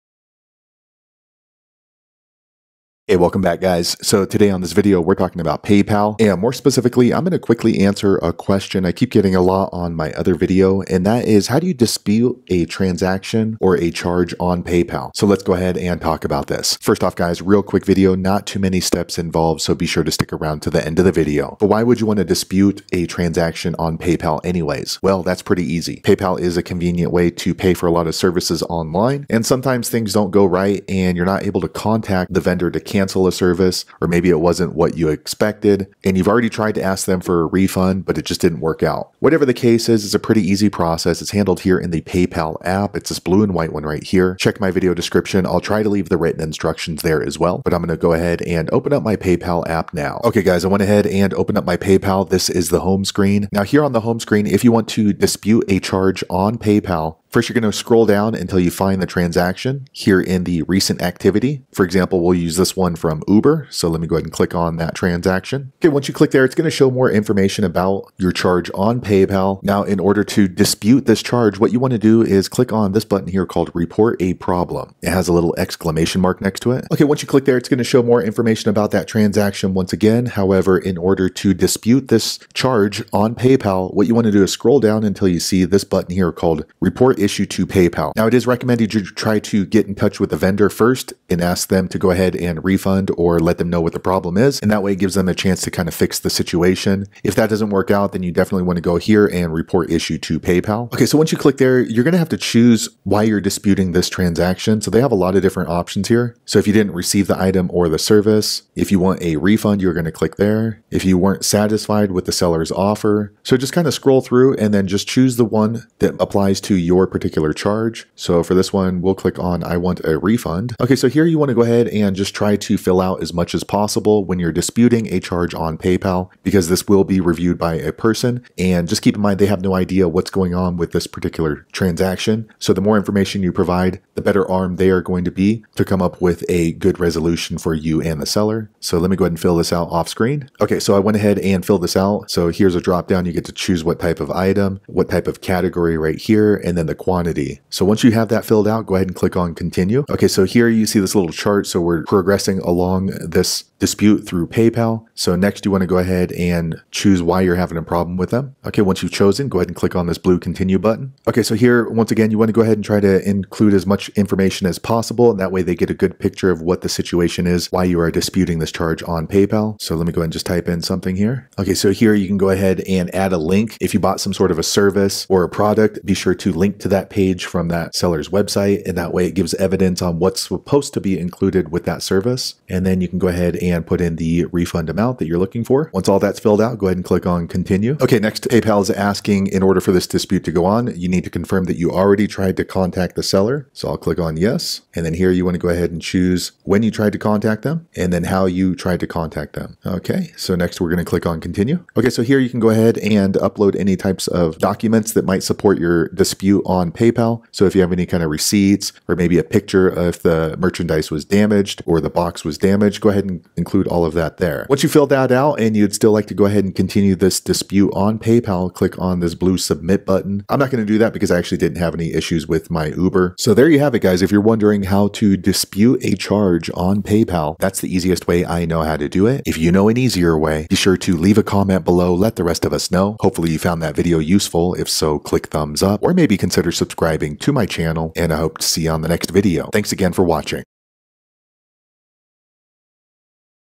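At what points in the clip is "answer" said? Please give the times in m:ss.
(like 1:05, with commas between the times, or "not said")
0:07.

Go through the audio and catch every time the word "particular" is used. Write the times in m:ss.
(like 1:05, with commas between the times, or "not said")
1:57, 2:11.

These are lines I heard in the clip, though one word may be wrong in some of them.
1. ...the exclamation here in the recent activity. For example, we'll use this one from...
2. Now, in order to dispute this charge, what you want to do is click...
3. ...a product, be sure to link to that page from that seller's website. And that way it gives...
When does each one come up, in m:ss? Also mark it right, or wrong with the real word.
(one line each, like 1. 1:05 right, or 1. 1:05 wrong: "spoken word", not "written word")
1. 0:59 wrong: "transaction", not "exclamation"
2. 1:09 right
3. 2:55 right.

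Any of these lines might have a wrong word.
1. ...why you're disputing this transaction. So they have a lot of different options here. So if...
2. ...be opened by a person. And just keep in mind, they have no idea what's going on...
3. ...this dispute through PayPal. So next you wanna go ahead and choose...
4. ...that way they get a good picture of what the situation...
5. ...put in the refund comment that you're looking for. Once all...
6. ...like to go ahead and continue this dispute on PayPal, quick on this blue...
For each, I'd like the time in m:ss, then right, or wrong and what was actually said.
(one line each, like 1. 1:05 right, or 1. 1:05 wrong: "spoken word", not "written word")
1. 1:43 right
2. 2:07 wrong: "reviewed", not "opened"
3. 2:33 right
4. 2:45 right
5. 3:03 wrong: "amount", not "comment"
6. 3:36 wrong: "click", not "quick".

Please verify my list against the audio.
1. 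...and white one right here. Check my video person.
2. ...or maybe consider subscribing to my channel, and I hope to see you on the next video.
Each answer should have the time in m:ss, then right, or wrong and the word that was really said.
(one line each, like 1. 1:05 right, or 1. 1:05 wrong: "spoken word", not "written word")
1. 0:43 wrong: "description", not "person"
2. 3:56 right.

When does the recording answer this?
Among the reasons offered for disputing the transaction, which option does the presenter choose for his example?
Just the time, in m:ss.
1:59.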